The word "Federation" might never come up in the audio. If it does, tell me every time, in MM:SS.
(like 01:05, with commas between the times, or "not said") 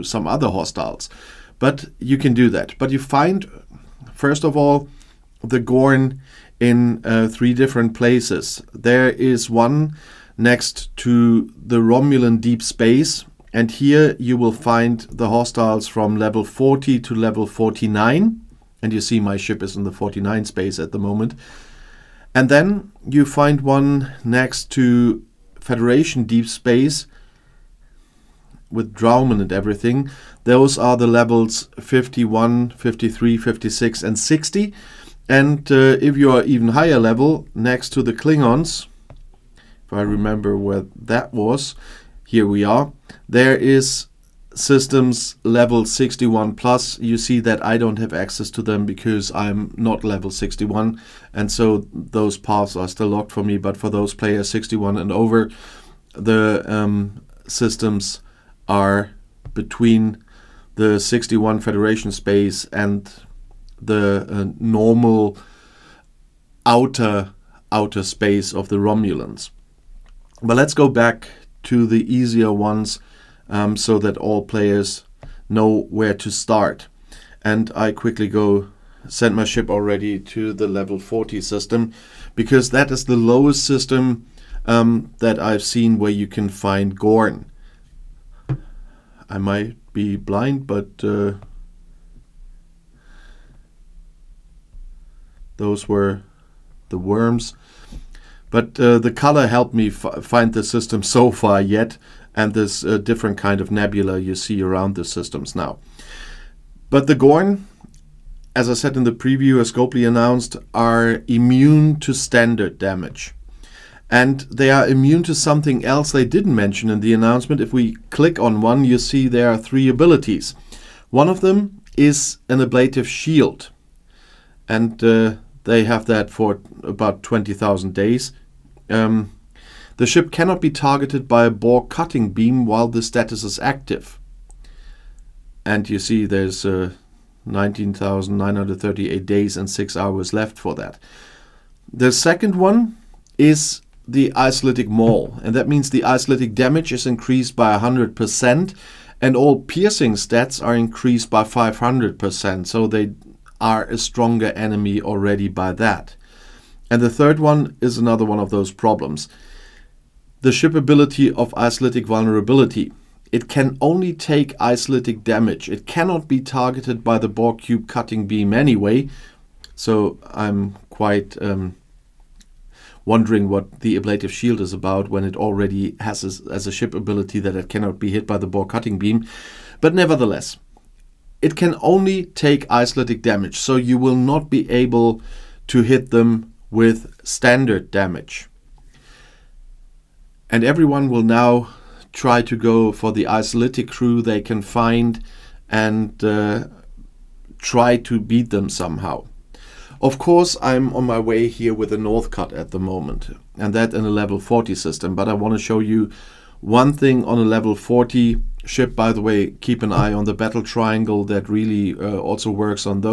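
00:25, 01:01.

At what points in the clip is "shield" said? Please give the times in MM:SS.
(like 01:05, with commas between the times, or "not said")
02:03, 02:54.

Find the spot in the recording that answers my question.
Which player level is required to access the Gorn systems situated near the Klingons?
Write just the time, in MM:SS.
00:45.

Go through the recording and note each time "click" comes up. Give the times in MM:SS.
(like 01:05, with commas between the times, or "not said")
01:58.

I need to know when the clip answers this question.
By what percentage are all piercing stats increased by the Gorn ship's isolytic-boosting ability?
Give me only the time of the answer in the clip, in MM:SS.
02:31.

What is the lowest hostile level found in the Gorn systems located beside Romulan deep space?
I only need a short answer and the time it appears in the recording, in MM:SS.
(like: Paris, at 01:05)
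40, at 00:16.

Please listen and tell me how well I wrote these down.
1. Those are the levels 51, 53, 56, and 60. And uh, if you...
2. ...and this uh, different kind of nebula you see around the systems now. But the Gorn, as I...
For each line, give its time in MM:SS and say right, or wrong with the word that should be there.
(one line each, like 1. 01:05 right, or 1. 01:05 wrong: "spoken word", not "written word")
1. 00:30 right
2. 01:42 right.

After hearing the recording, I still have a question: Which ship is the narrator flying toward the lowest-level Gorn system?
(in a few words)
Northcut.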